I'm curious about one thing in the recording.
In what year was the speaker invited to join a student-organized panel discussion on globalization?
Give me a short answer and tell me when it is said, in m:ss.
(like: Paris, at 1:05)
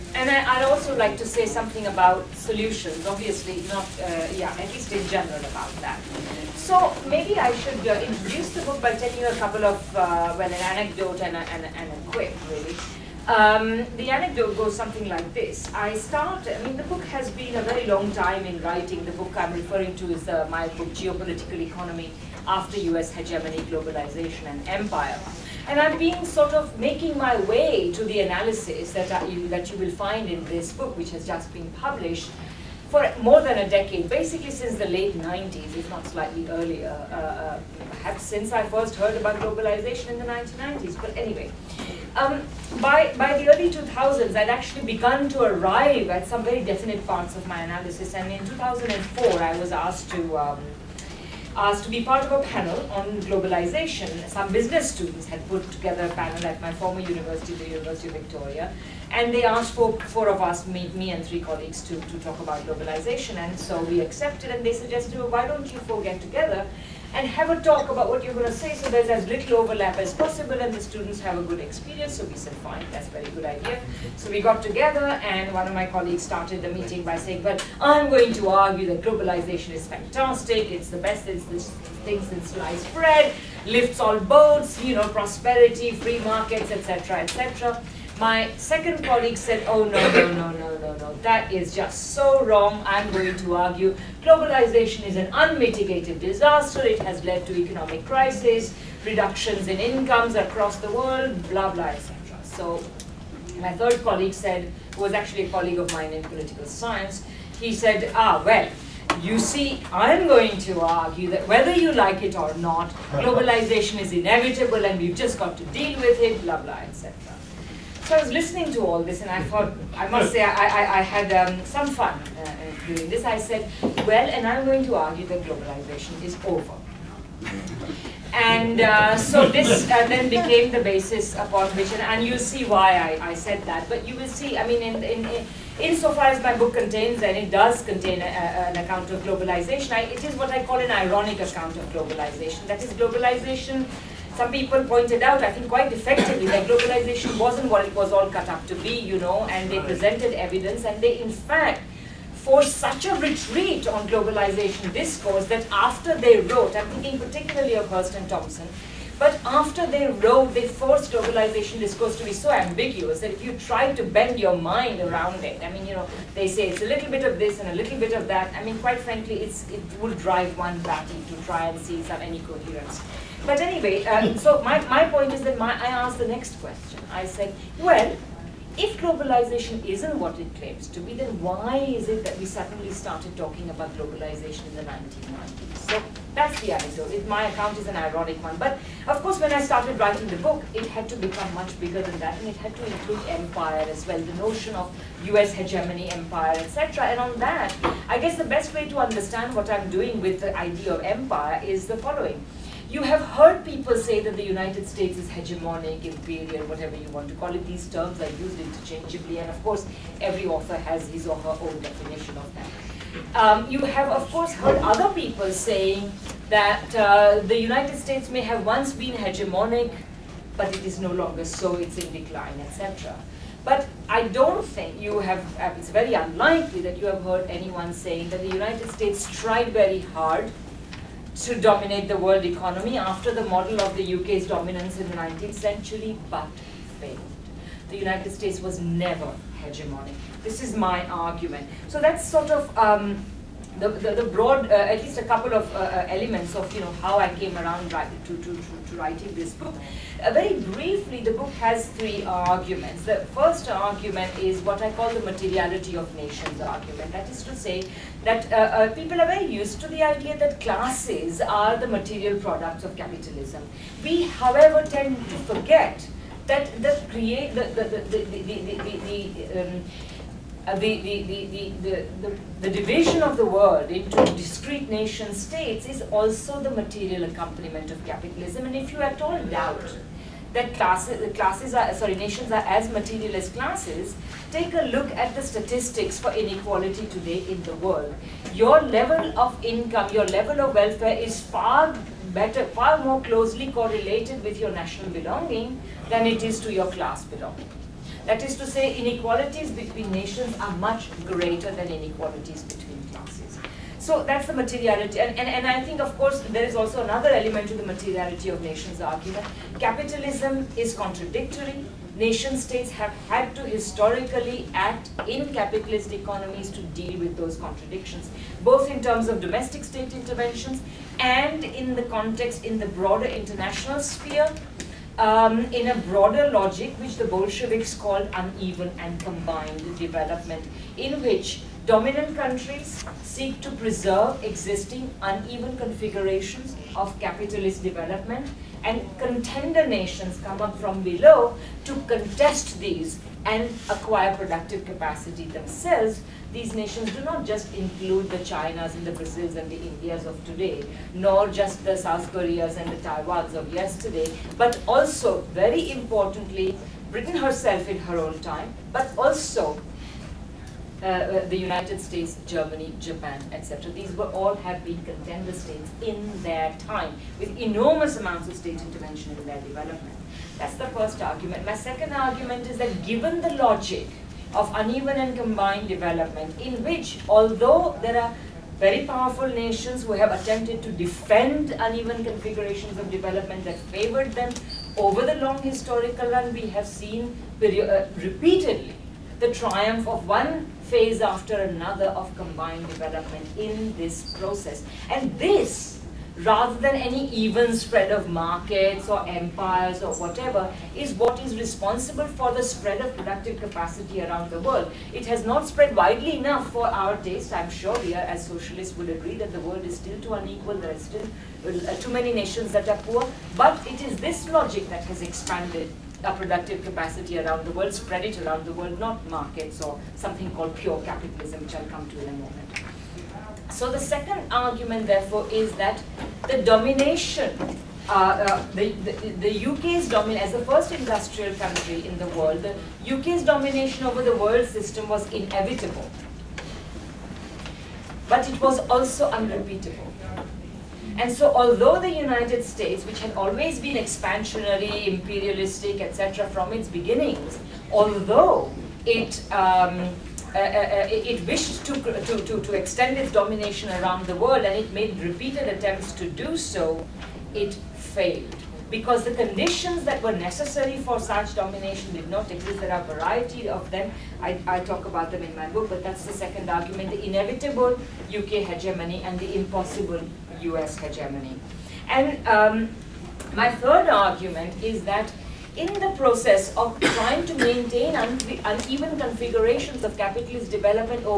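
2004, at 0:48.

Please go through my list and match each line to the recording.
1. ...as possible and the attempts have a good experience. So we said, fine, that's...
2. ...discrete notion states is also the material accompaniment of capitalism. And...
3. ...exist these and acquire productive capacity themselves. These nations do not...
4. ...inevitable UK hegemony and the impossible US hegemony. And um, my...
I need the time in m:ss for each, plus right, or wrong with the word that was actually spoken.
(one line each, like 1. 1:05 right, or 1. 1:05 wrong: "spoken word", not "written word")
1. 1:09 wrong: "students", not "attempts"
2. 4:34 wrong: "nation", not "notion"
3. 5:42 wrong: "contest", not "exist"
4. 7:47 right.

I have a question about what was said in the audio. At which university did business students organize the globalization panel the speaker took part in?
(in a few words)
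University of Victoria.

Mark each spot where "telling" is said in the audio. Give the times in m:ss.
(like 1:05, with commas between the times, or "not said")
0:08.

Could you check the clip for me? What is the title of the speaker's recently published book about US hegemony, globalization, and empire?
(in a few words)
Geopolitical Economy.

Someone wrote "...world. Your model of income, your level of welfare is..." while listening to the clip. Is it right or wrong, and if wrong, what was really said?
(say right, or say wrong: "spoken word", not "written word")
wrong: "level", not "model".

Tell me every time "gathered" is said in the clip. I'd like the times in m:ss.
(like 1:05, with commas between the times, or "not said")
not said.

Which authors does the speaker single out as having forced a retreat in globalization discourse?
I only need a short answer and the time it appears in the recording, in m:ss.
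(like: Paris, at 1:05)
Hirst and Thompson, at 2:37.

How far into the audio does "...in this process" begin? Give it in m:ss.
6:33.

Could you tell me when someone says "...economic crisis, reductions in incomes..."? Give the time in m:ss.
1:37.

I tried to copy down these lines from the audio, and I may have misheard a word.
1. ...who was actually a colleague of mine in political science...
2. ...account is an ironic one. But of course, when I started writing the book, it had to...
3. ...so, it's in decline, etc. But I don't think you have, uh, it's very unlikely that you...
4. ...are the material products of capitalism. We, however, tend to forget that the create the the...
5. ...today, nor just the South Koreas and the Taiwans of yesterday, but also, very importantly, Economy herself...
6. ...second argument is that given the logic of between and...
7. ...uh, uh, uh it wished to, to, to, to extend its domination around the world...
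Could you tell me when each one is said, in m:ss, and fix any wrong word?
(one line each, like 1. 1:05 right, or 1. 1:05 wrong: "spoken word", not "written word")
1. 1:44 right
2. 3:07 right
3. 3:41 right
4. 4:21 right
5. 5:50 wrong: "Britain", not "Economy"
6. 6:11 wrong: "uneven", not "between"
7. 7:30 right.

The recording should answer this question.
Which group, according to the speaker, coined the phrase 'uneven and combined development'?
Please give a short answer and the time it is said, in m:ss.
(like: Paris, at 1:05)
the Bolsheviks, at 5:27.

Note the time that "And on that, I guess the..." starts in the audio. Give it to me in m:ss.
3:17.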